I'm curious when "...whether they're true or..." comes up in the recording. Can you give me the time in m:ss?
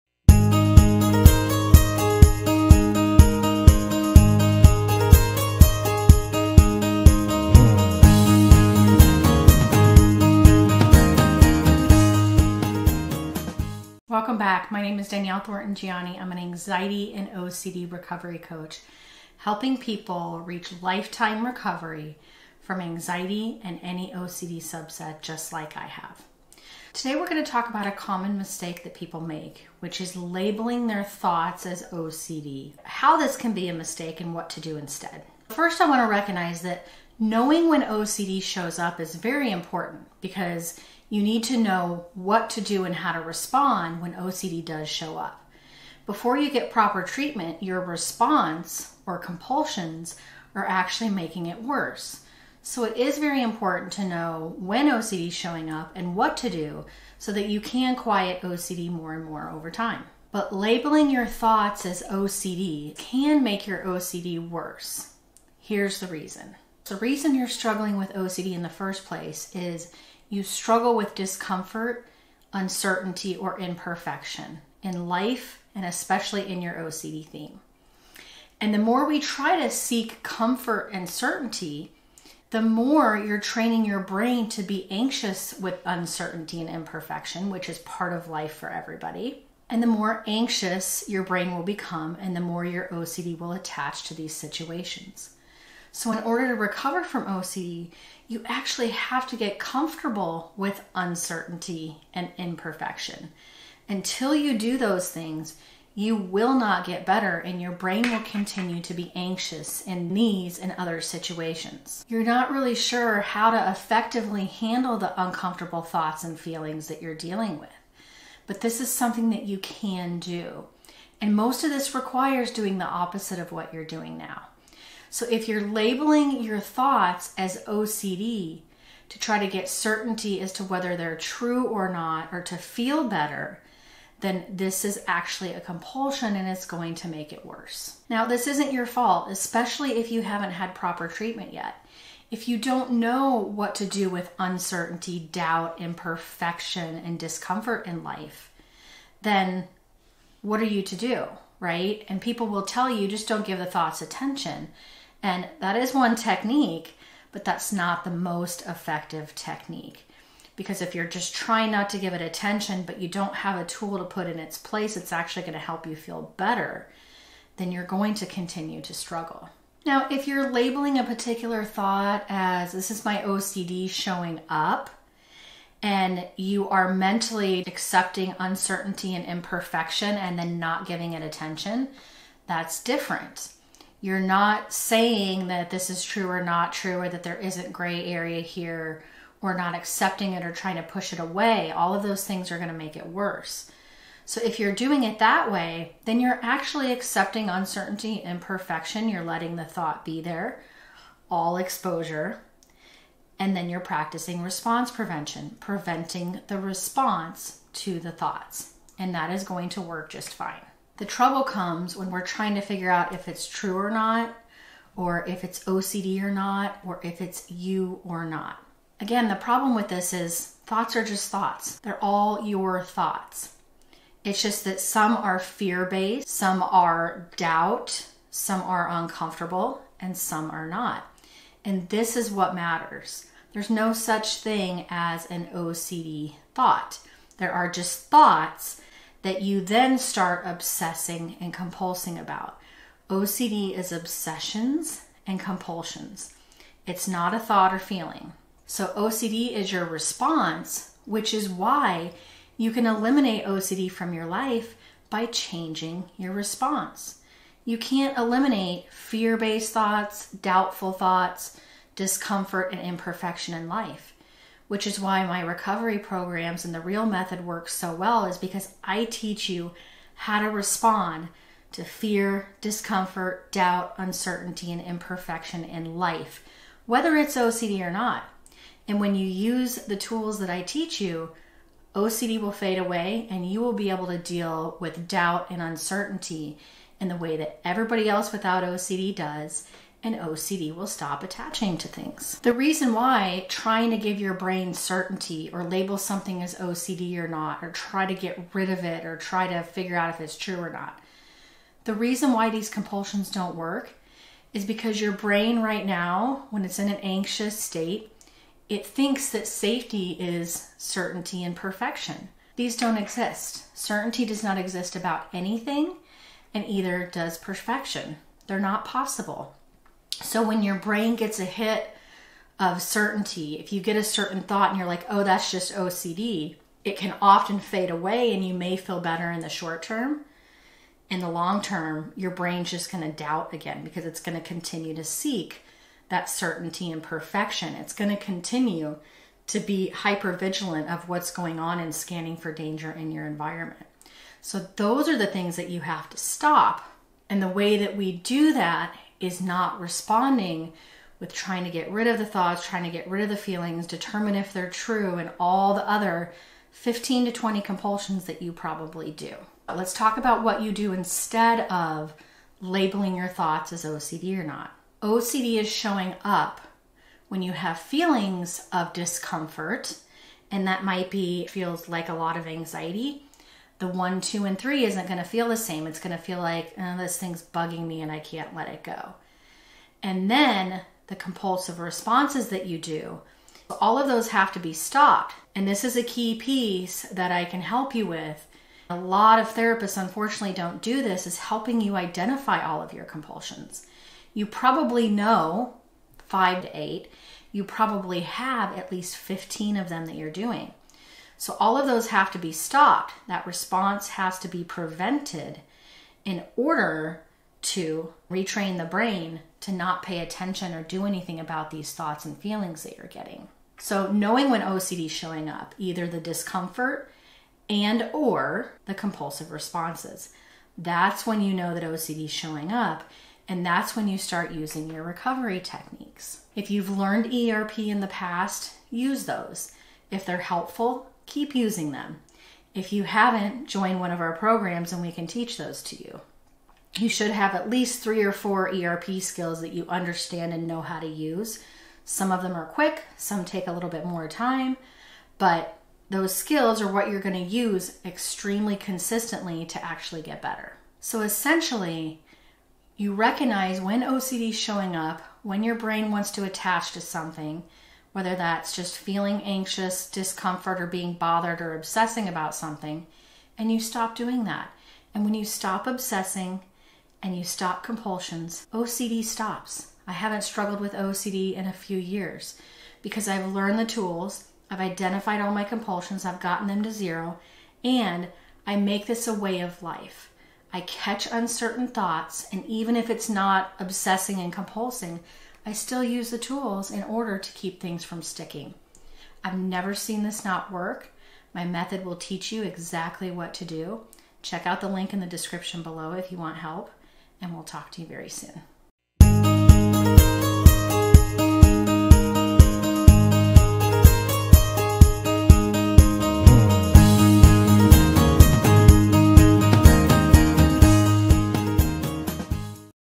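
2:10.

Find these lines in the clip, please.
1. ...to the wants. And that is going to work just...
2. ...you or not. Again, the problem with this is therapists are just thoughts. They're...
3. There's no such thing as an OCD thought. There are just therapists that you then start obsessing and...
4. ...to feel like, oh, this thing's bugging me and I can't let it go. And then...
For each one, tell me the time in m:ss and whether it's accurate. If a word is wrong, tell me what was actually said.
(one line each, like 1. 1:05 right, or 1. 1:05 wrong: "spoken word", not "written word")
1. 3:27 wrong: "thoughts", not "wants"
2. 3:37 wrong: "thoughts", not "therapists"
3. 3:53 wrong: "thoughts", not "therapists"
4. 6:16 right.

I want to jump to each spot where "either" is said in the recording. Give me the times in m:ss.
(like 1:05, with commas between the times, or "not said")
5:16, 6:55.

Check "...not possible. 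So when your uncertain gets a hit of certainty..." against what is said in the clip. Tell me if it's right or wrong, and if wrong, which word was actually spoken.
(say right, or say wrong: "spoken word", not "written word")
wrong: "brain", not "uncertain".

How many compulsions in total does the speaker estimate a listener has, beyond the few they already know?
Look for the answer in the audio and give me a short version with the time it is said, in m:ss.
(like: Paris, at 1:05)
15, at 6:38.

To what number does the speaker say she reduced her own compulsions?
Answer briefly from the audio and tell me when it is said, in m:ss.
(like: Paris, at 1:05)
0, at 7:56.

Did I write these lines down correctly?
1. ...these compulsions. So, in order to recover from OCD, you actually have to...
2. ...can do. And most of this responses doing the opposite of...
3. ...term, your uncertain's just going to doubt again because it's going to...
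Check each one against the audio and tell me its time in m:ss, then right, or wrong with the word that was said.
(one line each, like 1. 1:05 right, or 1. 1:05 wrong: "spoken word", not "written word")
1. 1:34 wrong: "situations", not "compulsions"
2. 1:59 wrong: "requires", not "responses"
3. 5:31 wrong: "brain", not "uncertain".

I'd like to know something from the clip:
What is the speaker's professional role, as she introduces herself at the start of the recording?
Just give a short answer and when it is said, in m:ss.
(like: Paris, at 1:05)
Anxiety and OCD recovery coach, at 0:16.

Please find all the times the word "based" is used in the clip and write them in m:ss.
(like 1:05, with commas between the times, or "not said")
3:45, 4:19.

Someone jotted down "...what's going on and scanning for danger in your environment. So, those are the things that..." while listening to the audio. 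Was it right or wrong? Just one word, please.
right.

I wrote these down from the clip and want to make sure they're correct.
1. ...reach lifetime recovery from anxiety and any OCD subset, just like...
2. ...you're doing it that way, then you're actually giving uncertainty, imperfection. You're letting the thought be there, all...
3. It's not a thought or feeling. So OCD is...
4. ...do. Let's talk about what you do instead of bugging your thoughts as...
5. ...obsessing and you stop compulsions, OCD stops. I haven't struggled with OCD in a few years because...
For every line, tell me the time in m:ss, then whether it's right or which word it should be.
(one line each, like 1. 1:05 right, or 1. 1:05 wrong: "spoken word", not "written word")
1. 0:20 right
2. 3:14 wrong: "accepting", not "giving"
3. 4:06 right
4. 5:59 wrong: "labeling", not "bugging"
5. 7:45 right.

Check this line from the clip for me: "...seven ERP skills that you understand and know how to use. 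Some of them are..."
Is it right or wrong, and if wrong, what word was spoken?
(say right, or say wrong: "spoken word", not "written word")
wrong: "four", not "seven".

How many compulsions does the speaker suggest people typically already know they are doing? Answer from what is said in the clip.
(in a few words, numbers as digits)
5 to 8.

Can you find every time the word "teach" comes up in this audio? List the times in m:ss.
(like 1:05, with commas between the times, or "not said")
4:29, 4:40, 7:15, 8:12.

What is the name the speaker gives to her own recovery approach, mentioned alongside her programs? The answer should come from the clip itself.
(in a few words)
The real method.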